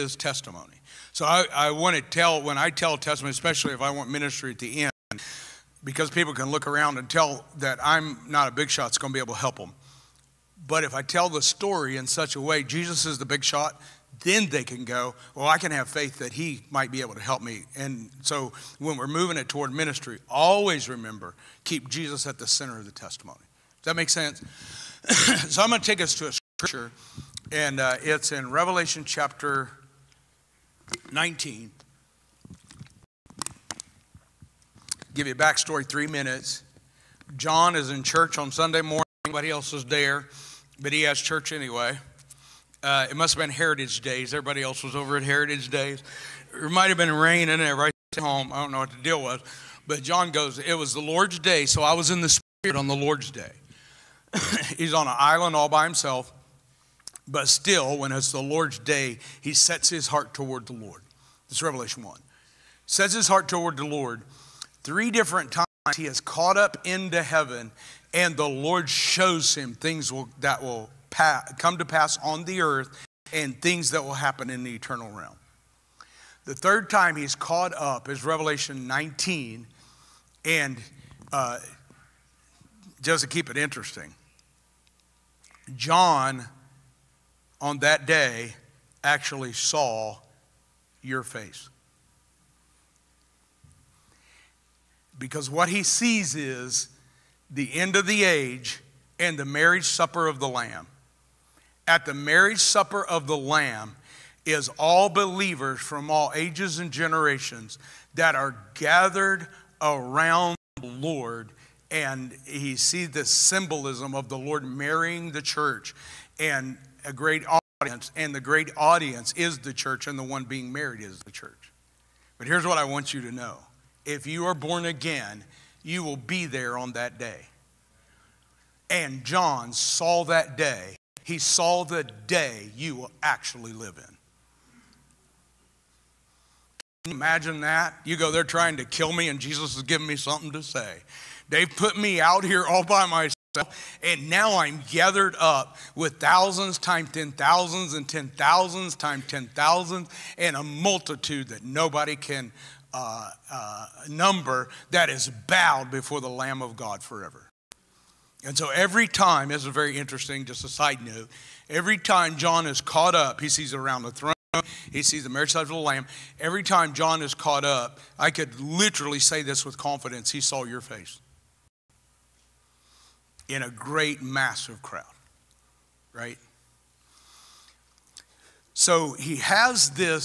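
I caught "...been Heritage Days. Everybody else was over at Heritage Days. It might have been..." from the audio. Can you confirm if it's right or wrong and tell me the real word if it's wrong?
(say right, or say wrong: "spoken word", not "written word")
right.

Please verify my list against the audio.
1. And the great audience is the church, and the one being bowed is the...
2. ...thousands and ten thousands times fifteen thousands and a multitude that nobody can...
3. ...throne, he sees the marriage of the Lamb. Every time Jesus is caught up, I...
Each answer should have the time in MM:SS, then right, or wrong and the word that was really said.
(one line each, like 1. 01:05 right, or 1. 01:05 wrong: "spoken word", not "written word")
1. 01:58 wrong: "married", not "bowed"
2. 02:27 wrong: "ten", not "fifteen"
3. 02:44 wrong: "John", not "Jesus".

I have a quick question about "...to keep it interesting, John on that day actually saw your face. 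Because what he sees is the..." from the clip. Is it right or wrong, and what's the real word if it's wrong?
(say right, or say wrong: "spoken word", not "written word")
right.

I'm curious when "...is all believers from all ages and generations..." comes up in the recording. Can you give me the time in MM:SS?
01:44.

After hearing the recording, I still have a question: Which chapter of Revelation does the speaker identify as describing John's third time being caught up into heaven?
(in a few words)
19.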